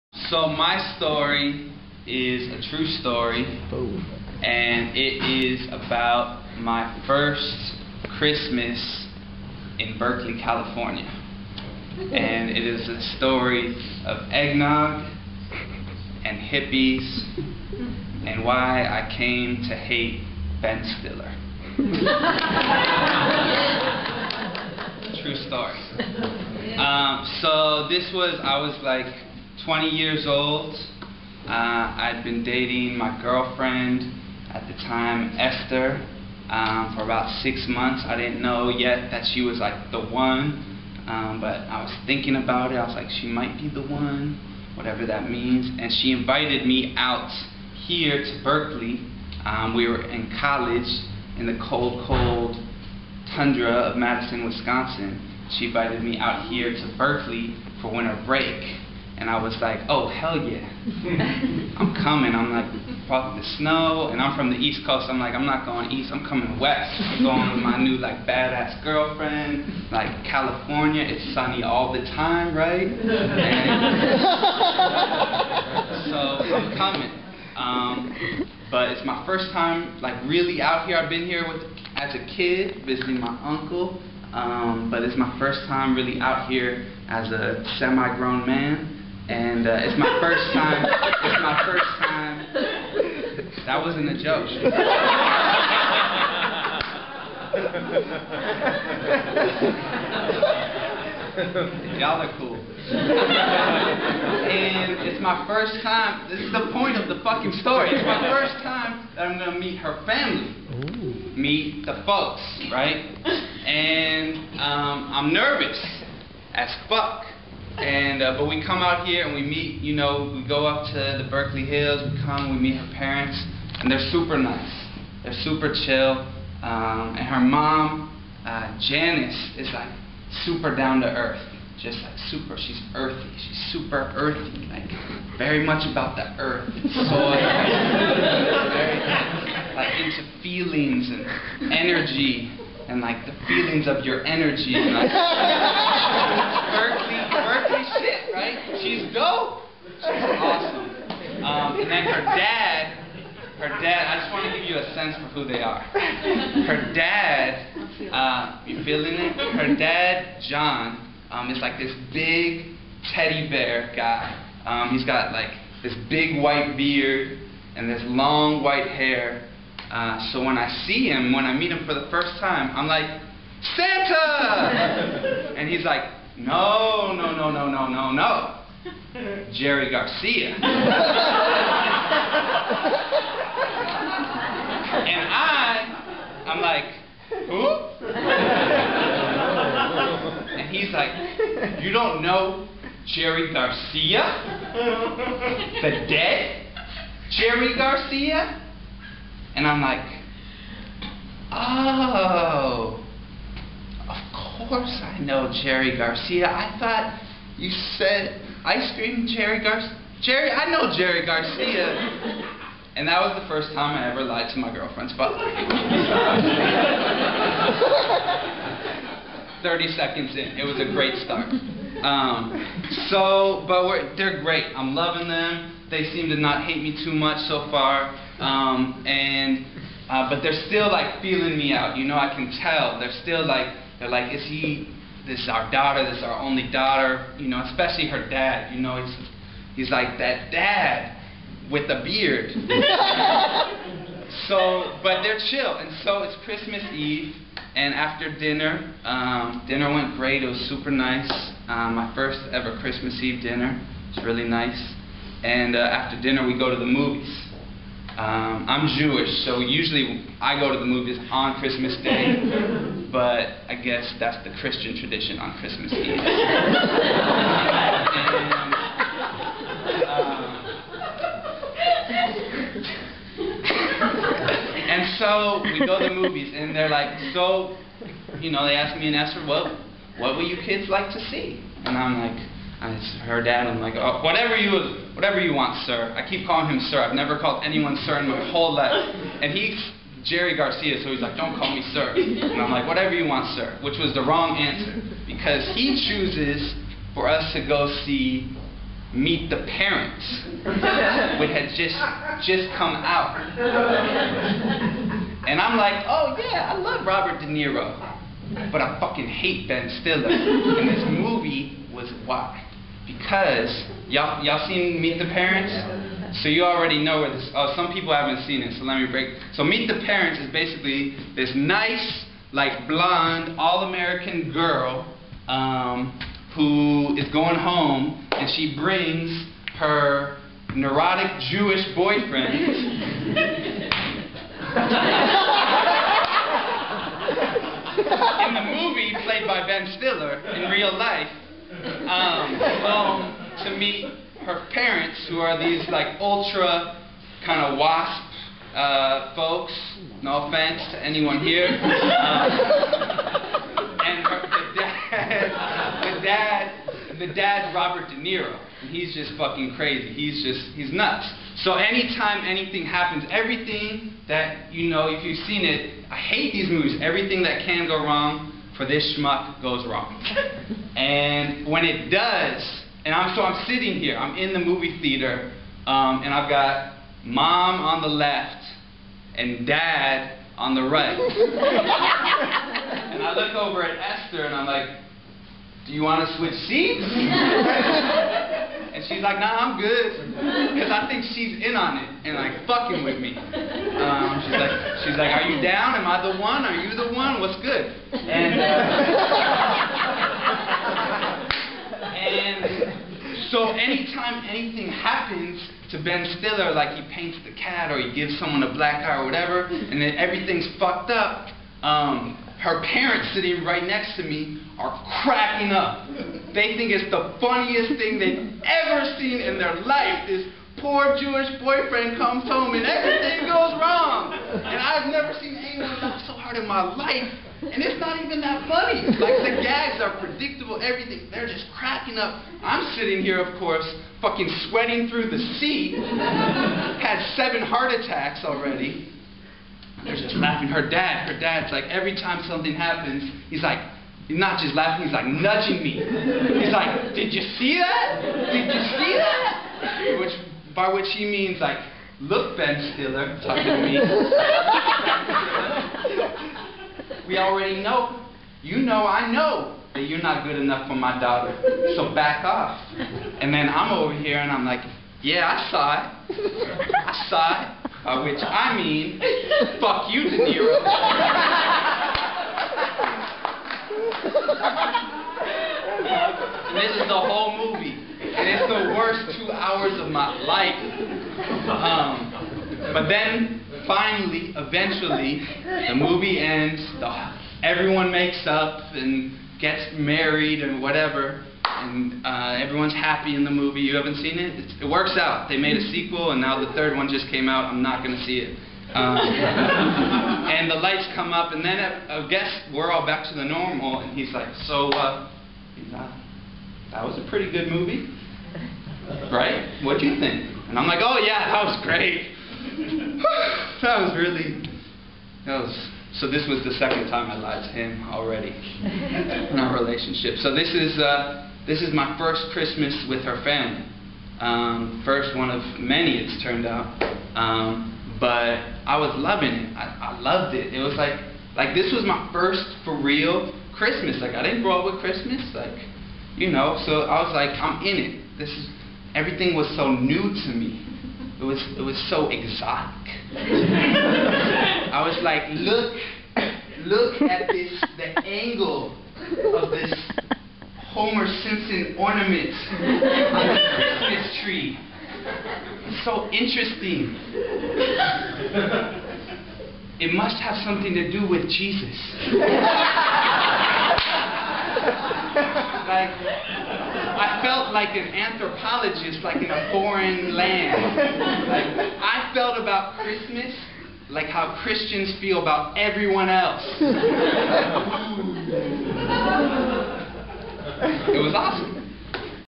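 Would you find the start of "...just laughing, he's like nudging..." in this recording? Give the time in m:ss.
7:24.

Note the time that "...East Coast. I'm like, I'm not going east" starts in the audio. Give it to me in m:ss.
1:04.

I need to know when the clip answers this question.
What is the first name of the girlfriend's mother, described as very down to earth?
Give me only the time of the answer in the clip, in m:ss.
2:08.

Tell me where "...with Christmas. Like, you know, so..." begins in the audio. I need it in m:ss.
8:54.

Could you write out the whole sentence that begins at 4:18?
Um, I'm Jewish, so usually I go to the movies on Christmas Day.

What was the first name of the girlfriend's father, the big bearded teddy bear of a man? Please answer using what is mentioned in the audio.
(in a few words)
John.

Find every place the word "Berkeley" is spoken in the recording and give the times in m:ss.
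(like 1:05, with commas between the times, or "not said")
0:09, 0:48, 0:56, 2:01.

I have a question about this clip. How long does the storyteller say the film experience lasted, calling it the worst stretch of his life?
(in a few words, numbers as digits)
2 hours.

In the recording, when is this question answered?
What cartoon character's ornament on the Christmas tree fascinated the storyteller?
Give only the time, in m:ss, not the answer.
9:10.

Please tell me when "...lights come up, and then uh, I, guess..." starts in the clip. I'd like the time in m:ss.
8:20.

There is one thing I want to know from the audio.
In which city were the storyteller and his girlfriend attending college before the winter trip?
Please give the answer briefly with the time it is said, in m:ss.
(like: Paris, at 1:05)
Madison, Wisconsin, at 0:53.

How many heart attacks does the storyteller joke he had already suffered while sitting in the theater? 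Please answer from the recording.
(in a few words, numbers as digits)
7.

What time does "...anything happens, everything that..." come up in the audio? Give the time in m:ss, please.
6:02.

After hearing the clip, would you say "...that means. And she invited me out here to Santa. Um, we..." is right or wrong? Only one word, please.
wrong.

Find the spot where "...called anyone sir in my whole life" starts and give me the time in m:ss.
4:47.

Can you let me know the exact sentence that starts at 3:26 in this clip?
I thought you said ice cream Jerry Garcia.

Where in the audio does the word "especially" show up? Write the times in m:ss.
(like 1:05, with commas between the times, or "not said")
3:57.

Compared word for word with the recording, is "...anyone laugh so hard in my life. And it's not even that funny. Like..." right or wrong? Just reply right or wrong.
right.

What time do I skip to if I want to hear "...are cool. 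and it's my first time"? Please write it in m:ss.
1:42.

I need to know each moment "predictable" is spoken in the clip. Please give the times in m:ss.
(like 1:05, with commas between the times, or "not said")
7:10.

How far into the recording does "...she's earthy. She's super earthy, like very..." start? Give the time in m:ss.
2:12.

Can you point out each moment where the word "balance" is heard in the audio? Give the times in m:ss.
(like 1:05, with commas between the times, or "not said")
not said.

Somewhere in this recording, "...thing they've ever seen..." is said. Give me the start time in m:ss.
6:57.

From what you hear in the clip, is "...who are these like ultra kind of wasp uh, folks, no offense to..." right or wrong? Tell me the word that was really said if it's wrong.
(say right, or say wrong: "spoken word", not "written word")
right.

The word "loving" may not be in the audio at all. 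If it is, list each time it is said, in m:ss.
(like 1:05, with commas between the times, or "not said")
3:44, 8:49.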